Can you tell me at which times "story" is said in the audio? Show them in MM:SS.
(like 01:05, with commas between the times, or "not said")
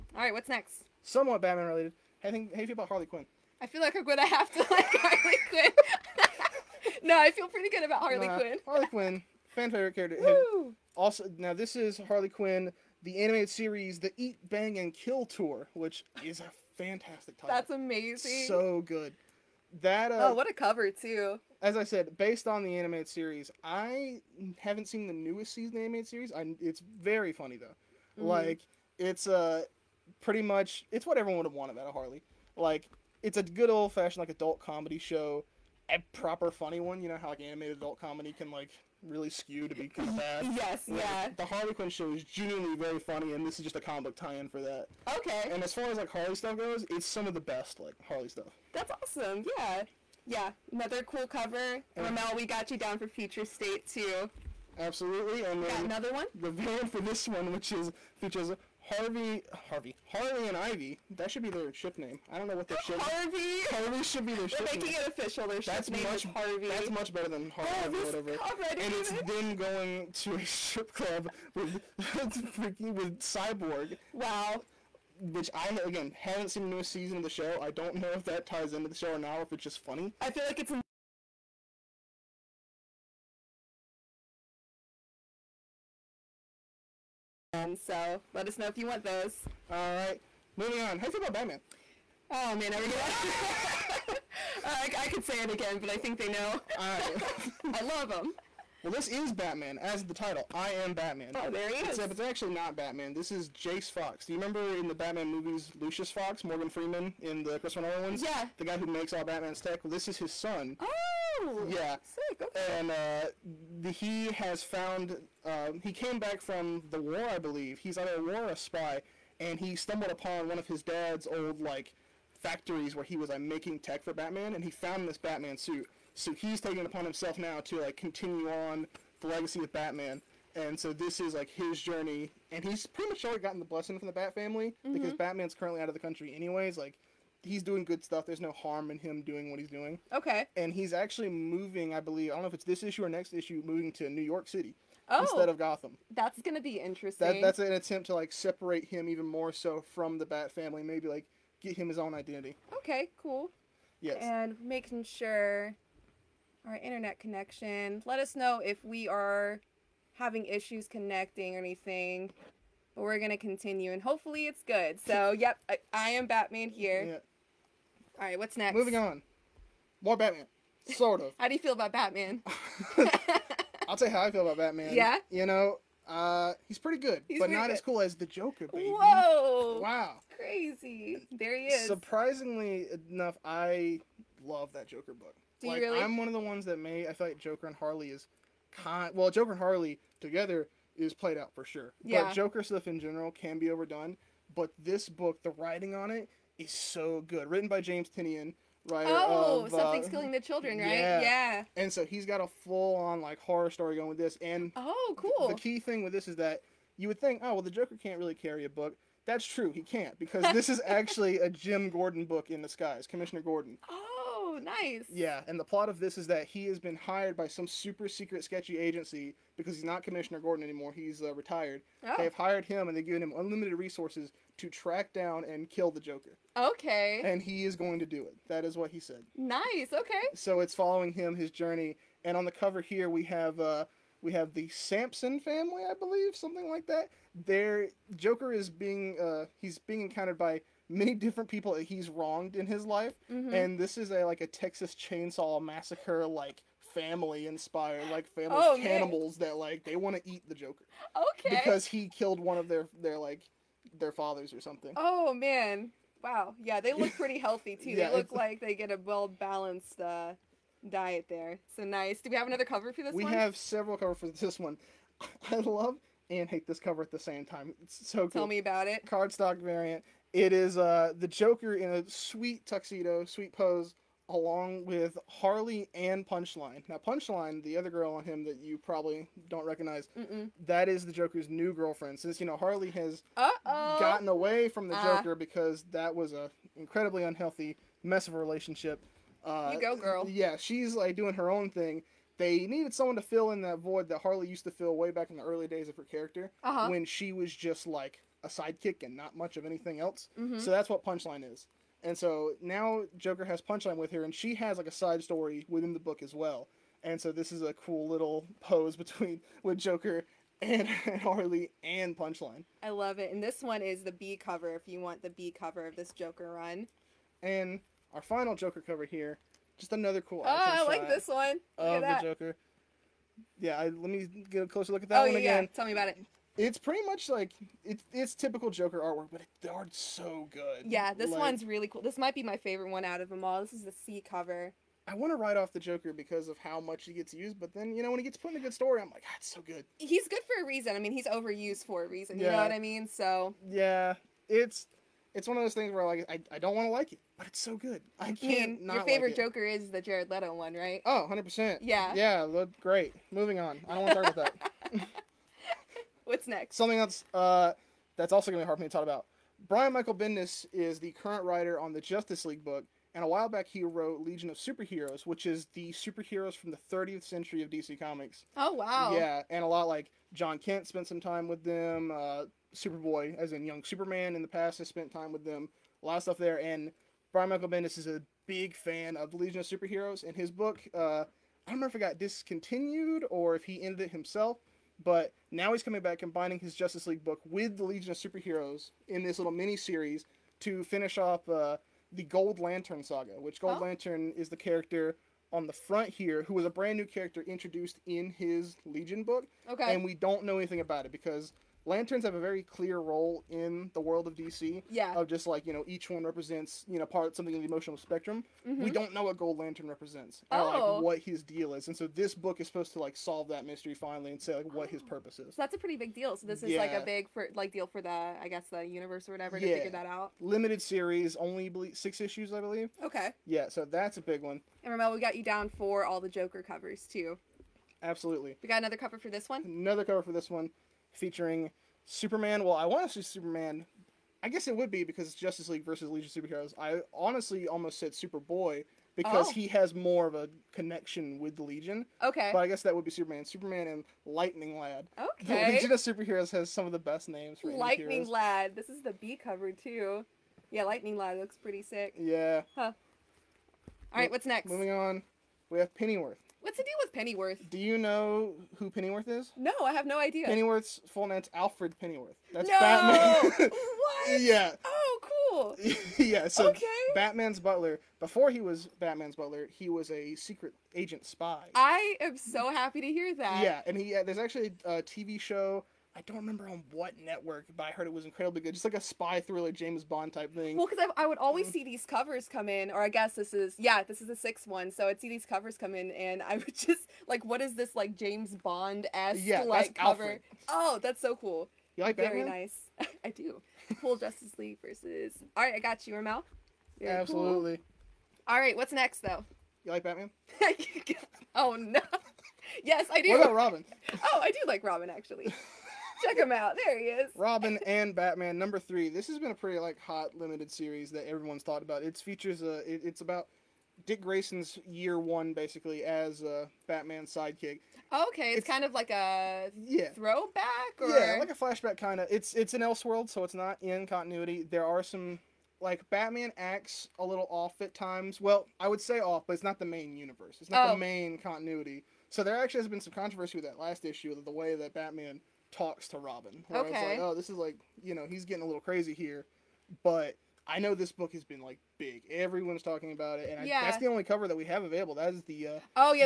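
03:23, 05:05, 05:38.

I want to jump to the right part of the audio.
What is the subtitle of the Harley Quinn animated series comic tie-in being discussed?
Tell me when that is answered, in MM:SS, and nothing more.
00:13.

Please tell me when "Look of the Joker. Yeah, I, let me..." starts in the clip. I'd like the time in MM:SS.
05:21.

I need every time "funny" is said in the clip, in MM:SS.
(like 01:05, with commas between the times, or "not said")
00:27, 00:36, 00:42, 01:19.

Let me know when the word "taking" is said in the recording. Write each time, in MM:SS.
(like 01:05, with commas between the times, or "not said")
02:06.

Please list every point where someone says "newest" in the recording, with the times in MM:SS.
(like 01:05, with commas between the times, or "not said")
00:25, 01:16.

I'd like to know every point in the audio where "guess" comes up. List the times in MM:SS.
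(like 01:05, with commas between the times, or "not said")
06:58, 07:14, 07:22, 08:03.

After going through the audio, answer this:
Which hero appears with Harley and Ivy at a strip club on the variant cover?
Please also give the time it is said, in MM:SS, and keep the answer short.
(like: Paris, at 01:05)
Cyborg, at 01:13.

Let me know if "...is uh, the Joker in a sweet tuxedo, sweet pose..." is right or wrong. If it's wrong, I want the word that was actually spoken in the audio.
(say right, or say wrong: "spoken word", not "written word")
right.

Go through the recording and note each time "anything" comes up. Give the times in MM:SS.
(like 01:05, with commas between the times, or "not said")
02:41, 04:59, 06:40.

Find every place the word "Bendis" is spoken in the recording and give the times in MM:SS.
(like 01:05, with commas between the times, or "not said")
06:00, 06:17.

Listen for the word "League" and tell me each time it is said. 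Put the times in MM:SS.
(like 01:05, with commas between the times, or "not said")
06:02, 06:27, 07:15, 08:14.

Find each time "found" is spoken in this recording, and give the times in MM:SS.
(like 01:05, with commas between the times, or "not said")
01:54, 02:04.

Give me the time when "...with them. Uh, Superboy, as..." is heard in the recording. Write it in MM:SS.
06:11.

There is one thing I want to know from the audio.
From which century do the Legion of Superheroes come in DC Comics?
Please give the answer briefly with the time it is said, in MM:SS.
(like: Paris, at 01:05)
30th century, at 06:06.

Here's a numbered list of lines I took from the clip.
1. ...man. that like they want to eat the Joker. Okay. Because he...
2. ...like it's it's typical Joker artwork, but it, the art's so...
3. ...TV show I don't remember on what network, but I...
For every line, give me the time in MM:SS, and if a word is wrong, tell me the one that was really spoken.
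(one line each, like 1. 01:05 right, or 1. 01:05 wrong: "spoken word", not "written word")
1. 04:09 right
2. 05:27 right
3. 07:55 right.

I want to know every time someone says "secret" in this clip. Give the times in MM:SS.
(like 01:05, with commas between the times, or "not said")
03:38, 07:50.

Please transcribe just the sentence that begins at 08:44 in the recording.
There are some like Batman acts a little off at times.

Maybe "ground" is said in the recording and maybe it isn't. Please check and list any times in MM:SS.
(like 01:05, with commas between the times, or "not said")
not said.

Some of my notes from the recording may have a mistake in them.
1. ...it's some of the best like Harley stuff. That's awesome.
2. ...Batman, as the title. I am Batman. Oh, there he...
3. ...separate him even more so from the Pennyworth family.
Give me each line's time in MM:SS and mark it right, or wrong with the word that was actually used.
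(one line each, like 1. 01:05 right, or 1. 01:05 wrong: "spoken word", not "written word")
1. 00:46 right
2. 01:39 right
3. 02:28 wrong: "Bat", not "Pennyworth".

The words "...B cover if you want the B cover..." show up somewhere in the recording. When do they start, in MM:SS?
05:14.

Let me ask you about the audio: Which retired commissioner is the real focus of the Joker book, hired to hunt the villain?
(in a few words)
Jim Gordon.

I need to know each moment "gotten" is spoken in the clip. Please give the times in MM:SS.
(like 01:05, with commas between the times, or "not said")
02:13, 04:43.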